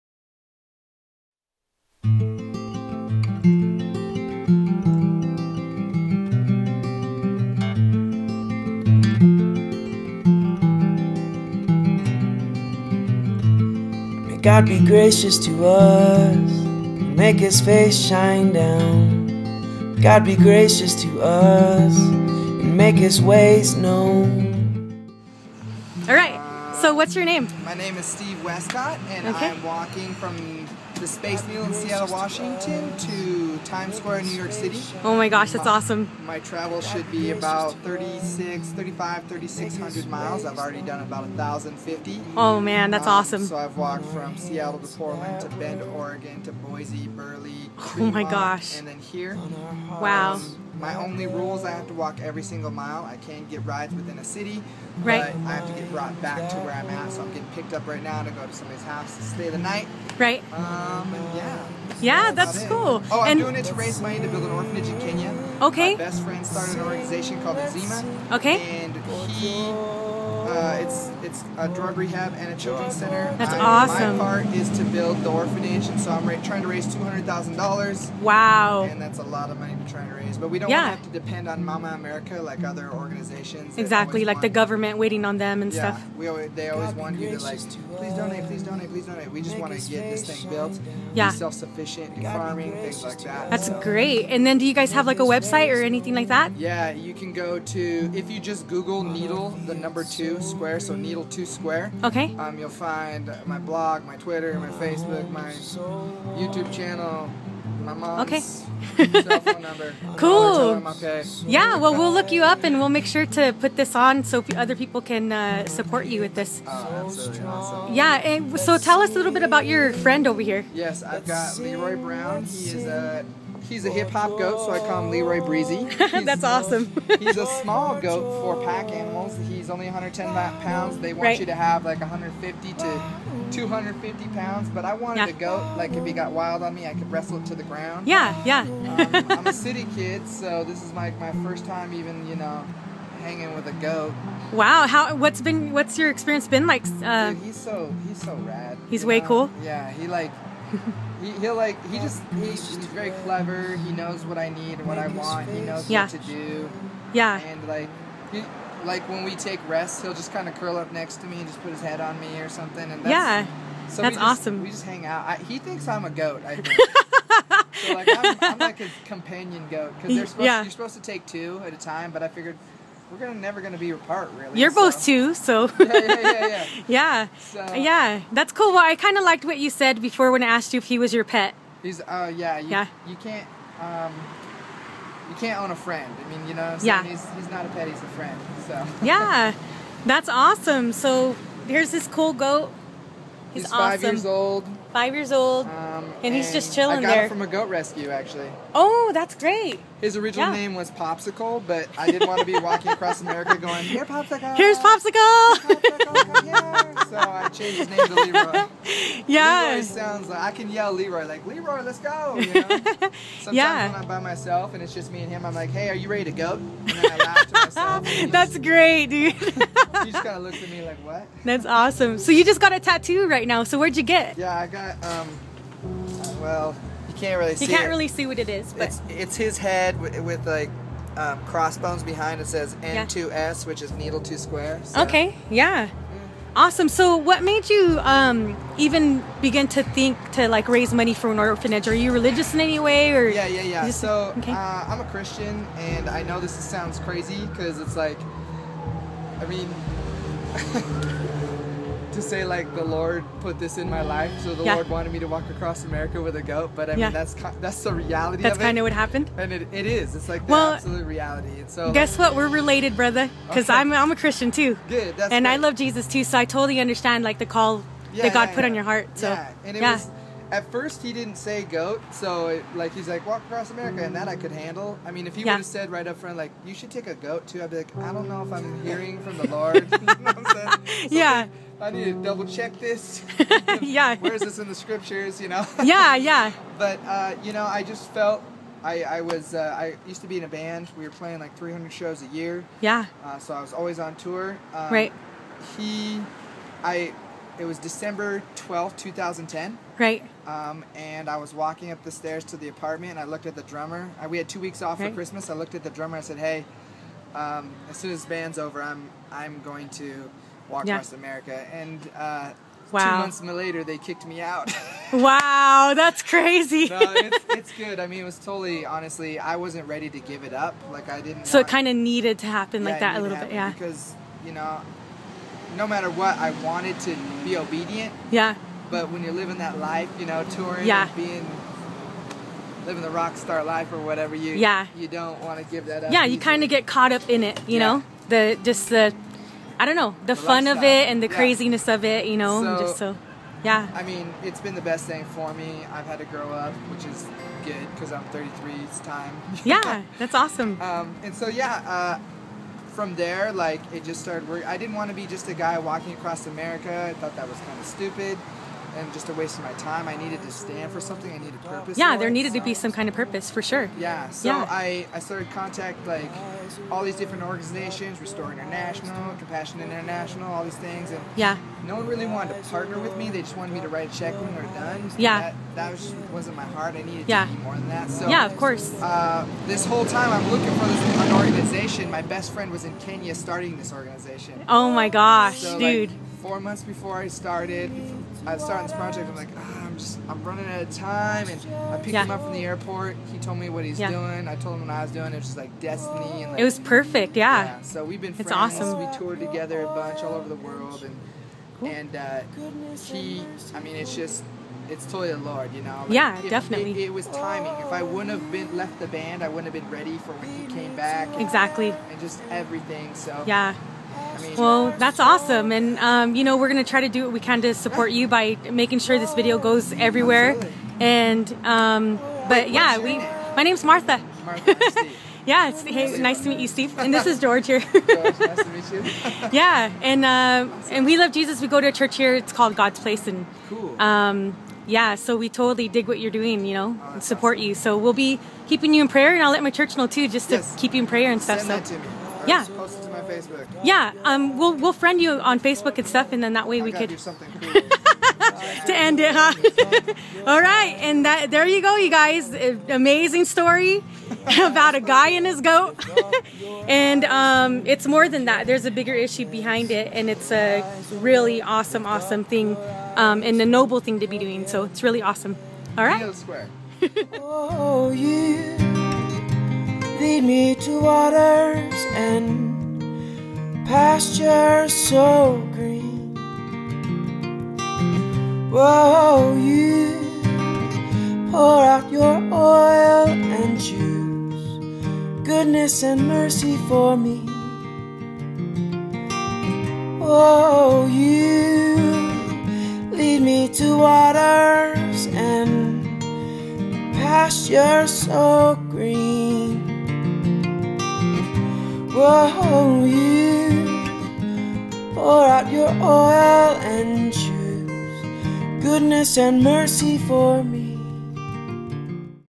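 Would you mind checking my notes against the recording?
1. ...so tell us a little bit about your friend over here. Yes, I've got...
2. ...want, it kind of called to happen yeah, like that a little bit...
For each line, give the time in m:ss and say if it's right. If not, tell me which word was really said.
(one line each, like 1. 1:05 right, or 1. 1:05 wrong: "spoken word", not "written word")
1. 1:58 right
2. 5:21 wrong: "needed", not "called".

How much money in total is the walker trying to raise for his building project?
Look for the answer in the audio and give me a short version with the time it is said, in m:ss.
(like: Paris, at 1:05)
$200,000, at 1:16.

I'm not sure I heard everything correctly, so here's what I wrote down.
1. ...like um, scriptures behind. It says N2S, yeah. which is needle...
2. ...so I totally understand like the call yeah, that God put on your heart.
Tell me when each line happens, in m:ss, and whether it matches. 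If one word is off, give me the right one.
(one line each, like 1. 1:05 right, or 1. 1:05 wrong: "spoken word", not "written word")
1. 3:50 wrong: "crossbones", not "scriptures"
2. 4:26 right.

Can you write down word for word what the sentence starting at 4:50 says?
We were playing like 300 shows a year.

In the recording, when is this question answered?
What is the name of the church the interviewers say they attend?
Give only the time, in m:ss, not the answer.
7:12.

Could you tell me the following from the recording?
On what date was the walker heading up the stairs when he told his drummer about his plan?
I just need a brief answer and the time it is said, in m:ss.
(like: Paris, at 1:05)
December 12, 2010, at 4:57.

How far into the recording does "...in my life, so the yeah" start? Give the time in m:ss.
4:13.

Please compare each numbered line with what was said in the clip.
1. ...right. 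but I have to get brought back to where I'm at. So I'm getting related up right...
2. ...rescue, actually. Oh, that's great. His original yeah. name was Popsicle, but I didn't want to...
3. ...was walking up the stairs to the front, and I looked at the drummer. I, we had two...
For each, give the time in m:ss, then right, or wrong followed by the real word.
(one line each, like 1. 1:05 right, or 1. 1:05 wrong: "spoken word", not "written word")
1. 0:55 wrong: "picked", not "related"
2. 3:17 right
3. 5:01 wrong: "apartment", not "front".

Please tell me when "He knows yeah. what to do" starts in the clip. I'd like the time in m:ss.
2:35.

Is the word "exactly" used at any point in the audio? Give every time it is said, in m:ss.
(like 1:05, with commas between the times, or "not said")
1:23, 6:51.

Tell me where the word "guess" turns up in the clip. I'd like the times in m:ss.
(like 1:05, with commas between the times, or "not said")
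4:21.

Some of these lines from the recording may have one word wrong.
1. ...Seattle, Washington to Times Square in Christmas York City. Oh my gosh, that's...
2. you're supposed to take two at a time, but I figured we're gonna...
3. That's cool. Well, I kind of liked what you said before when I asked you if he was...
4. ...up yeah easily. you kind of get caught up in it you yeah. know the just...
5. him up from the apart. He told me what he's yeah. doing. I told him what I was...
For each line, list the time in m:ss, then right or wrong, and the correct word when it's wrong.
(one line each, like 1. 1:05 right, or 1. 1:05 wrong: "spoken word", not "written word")
1. 0:31 wrong: "New", not "Christmas"
2. 2:50 right
3. 2:58 right
4. 5:36 right
5. 6:32 wrong: "airport", not "apart".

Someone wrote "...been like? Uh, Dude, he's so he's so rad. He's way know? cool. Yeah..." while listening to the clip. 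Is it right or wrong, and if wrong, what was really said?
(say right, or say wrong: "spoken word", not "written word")
right.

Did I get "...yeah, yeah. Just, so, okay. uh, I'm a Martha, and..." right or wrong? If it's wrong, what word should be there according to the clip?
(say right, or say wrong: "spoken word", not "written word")
wrong: "Christian", not "Martha".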